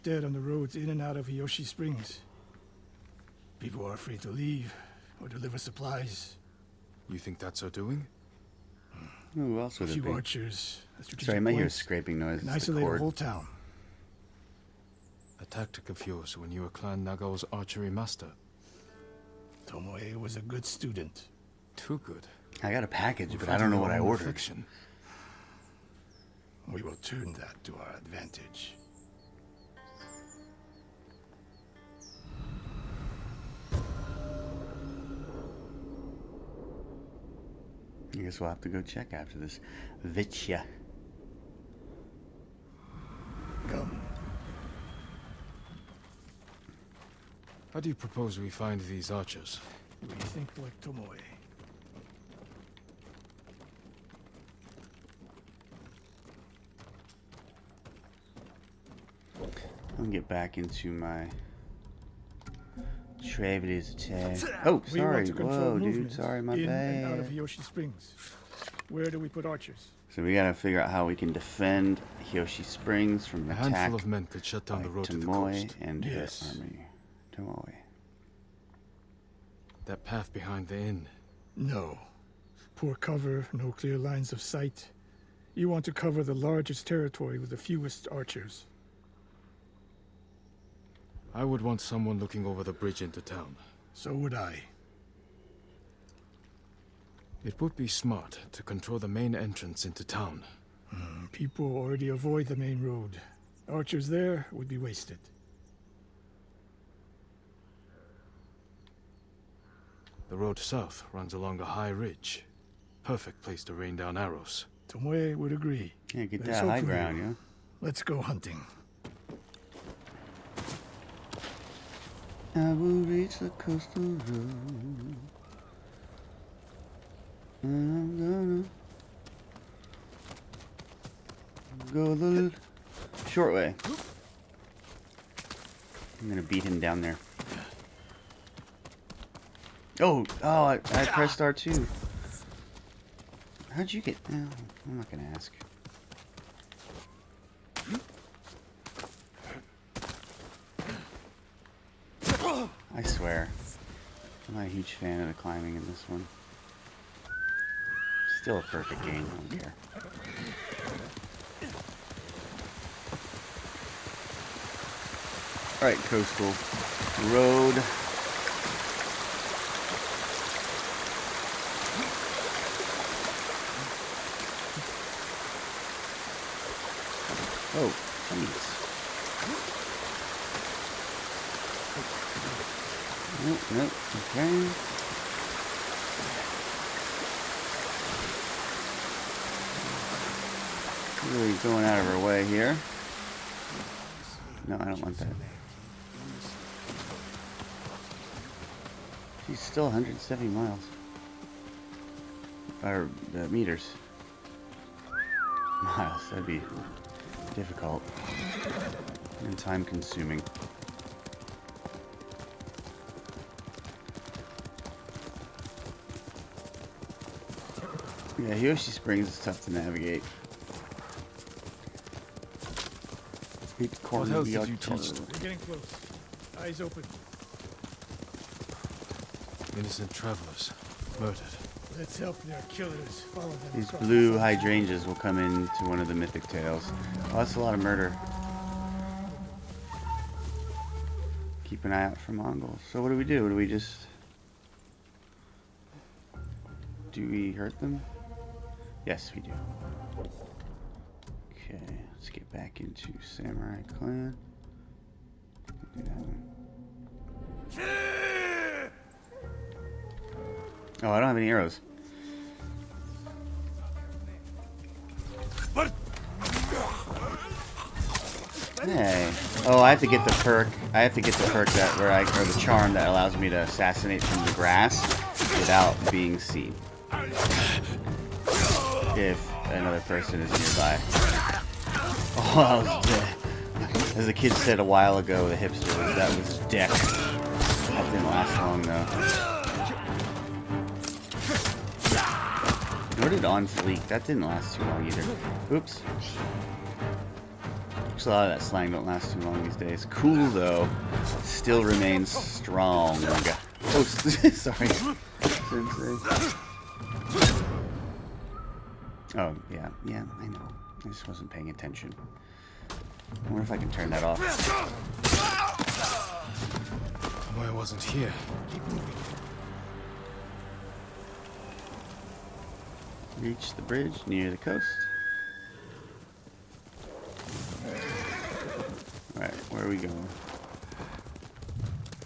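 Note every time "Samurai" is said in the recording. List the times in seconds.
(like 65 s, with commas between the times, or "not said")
253 s.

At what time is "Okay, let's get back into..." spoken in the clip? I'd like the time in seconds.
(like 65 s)
251 s.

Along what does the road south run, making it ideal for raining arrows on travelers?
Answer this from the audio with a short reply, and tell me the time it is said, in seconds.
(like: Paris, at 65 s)
A high ridge, at 111 s.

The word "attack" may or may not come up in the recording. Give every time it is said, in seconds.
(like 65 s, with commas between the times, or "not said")
63 s, 73 s.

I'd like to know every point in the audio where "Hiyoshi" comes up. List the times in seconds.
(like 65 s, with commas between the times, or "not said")
1 s, 67 s.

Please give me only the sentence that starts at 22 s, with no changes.
I got a package, we but I don't know what I ordered.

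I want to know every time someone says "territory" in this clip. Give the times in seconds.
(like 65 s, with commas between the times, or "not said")
86 s.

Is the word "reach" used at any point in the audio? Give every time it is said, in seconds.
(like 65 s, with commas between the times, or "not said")
123 s, 323 s.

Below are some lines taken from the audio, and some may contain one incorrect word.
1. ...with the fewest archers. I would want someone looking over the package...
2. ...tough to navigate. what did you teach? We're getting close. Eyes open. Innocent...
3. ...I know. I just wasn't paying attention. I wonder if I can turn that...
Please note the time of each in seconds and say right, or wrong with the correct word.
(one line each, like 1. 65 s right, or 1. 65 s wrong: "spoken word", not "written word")
1. 87 s wrong: "bridge", not "package"
2. 219 s right
3. 310 s right.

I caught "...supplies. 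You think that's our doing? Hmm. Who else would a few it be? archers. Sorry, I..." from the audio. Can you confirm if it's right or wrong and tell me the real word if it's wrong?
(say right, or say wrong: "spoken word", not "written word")
right.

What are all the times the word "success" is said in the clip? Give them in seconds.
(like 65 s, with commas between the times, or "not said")
not said.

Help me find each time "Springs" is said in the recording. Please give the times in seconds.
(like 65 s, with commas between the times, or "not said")
1 s, 67 s, 72 s, 218 s.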